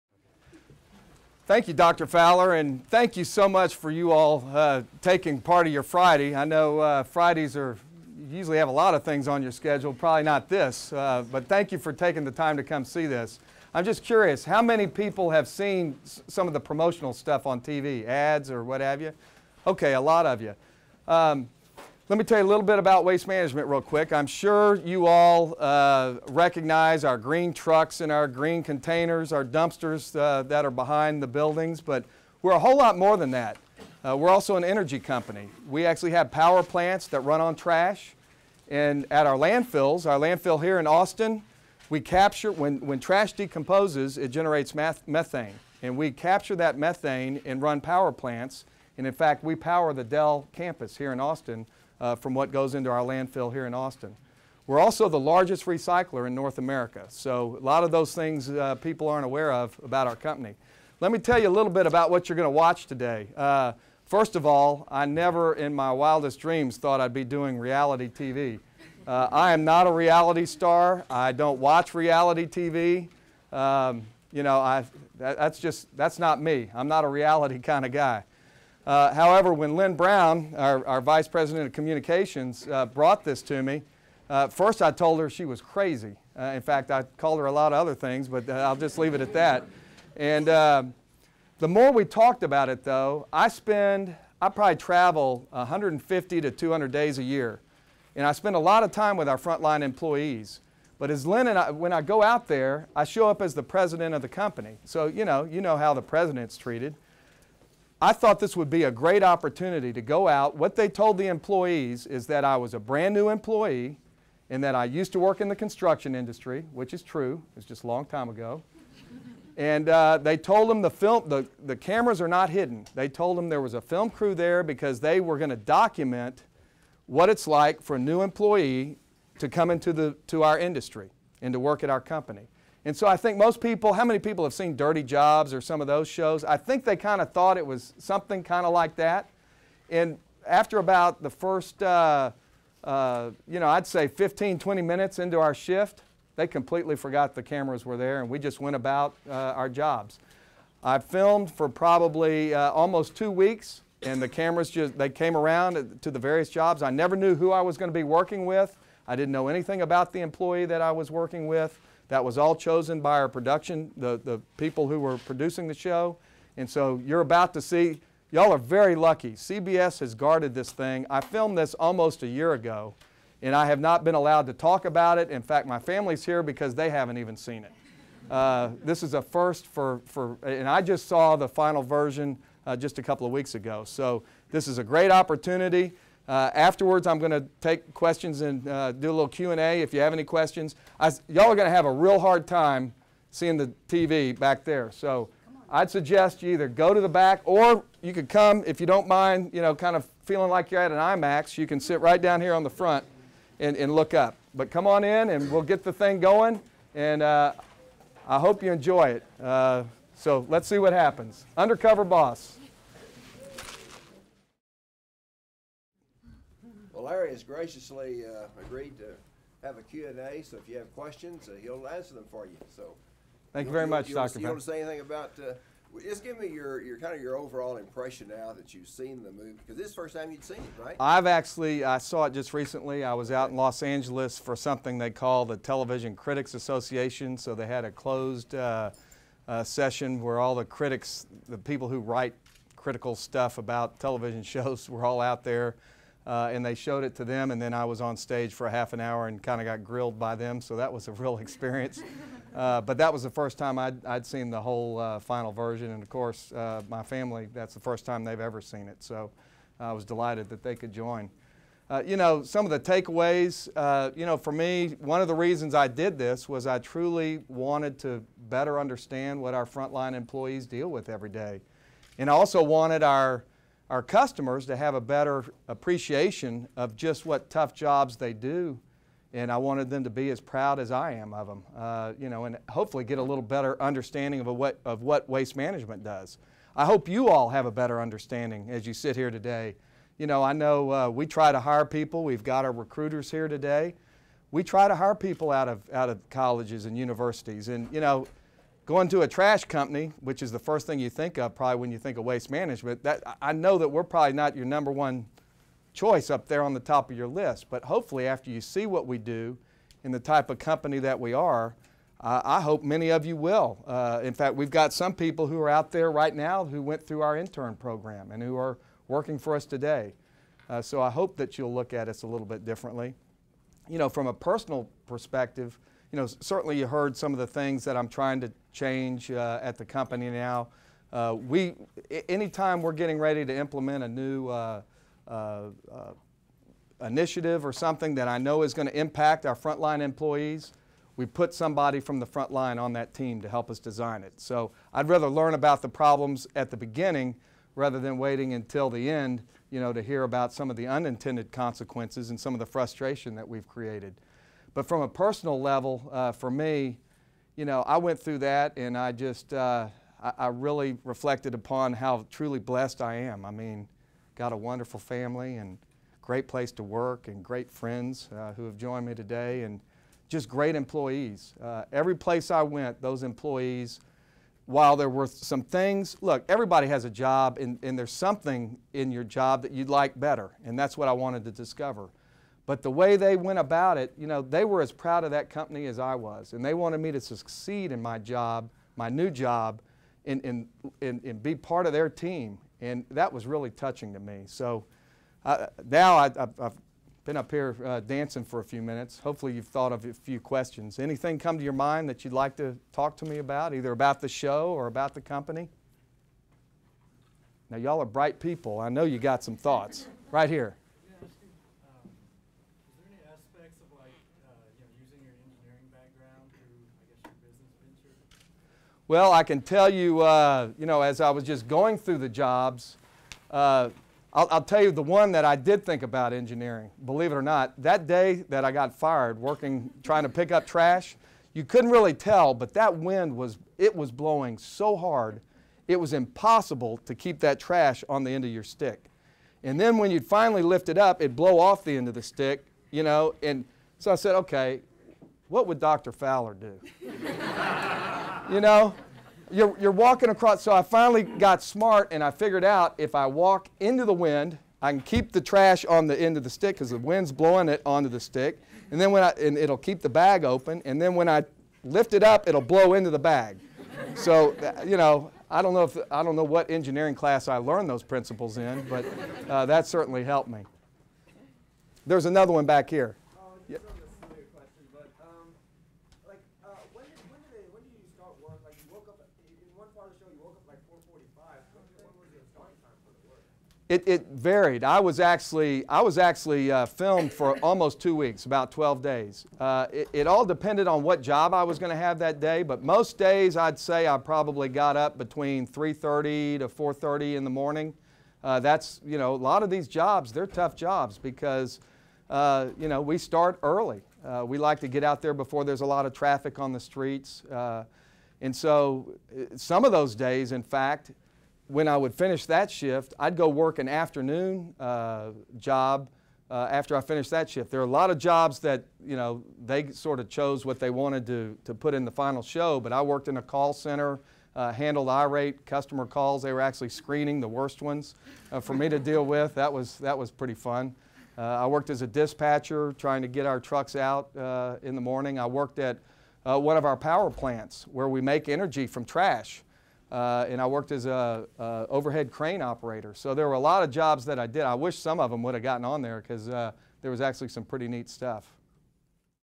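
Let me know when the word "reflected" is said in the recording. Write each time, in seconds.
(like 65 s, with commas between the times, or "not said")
361 s.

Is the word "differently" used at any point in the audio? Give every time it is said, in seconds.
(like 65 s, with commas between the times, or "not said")
322 s.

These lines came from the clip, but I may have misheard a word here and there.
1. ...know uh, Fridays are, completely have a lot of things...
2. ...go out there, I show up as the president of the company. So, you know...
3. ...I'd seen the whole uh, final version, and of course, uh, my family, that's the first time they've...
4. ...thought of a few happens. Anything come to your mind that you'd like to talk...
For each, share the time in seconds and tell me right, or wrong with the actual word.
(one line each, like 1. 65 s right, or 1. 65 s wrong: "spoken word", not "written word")
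1. 6 s wrong: "usually", not "completely"
2. 102 s right
3. 254 s right
4. 399 s wrong: "questions", not "happens".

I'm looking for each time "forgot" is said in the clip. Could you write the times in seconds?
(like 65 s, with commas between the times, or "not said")
146 s.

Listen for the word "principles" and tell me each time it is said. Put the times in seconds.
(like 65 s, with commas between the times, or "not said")
468 s.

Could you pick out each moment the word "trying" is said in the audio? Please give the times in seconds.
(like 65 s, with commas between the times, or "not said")
328 s, 430 s, 532 s.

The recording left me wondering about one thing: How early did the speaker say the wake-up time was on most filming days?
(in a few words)
3:30 a.m.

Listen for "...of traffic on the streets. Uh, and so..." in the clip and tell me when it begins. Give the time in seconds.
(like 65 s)
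506 s.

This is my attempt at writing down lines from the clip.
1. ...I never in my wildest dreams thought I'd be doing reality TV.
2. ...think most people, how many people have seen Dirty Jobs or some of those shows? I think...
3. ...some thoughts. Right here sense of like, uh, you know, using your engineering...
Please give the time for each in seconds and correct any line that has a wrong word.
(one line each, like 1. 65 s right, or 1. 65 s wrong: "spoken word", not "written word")
1. 64 s right
2. 133 s right
3. 409 s right.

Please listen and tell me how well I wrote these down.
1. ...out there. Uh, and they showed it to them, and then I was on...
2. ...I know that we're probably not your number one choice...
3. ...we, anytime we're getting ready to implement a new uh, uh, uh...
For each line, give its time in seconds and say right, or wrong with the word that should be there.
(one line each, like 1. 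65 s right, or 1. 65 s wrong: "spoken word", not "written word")
1. 245 s right
2. 303 s right
3. 331 s right.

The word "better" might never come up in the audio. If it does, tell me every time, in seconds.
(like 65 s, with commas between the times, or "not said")
268 s, 275 s, 283 s, 287 s, 380 s.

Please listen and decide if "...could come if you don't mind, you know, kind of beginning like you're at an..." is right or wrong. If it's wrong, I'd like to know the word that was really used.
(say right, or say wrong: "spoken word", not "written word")
wrong: "feeling", not "beginning".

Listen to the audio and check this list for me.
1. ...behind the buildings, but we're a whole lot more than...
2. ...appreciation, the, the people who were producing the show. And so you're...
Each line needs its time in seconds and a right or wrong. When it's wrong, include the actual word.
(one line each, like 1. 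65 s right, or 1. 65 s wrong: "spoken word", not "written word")
1. 30 s right
2. 163 s wrong: "production", not "appreciation".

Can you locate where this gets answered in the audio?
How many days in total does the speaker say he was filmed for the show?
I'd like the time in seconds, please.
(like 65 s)
488 s.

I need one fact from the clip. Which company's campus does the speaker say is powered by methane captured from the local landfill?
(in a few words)
Dell.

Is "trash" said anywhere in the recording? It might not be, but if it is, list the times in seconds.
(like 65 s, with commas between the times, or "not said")
37 s, 42 s, 299 s, 430 s, 437 s, 455 s, 539 s.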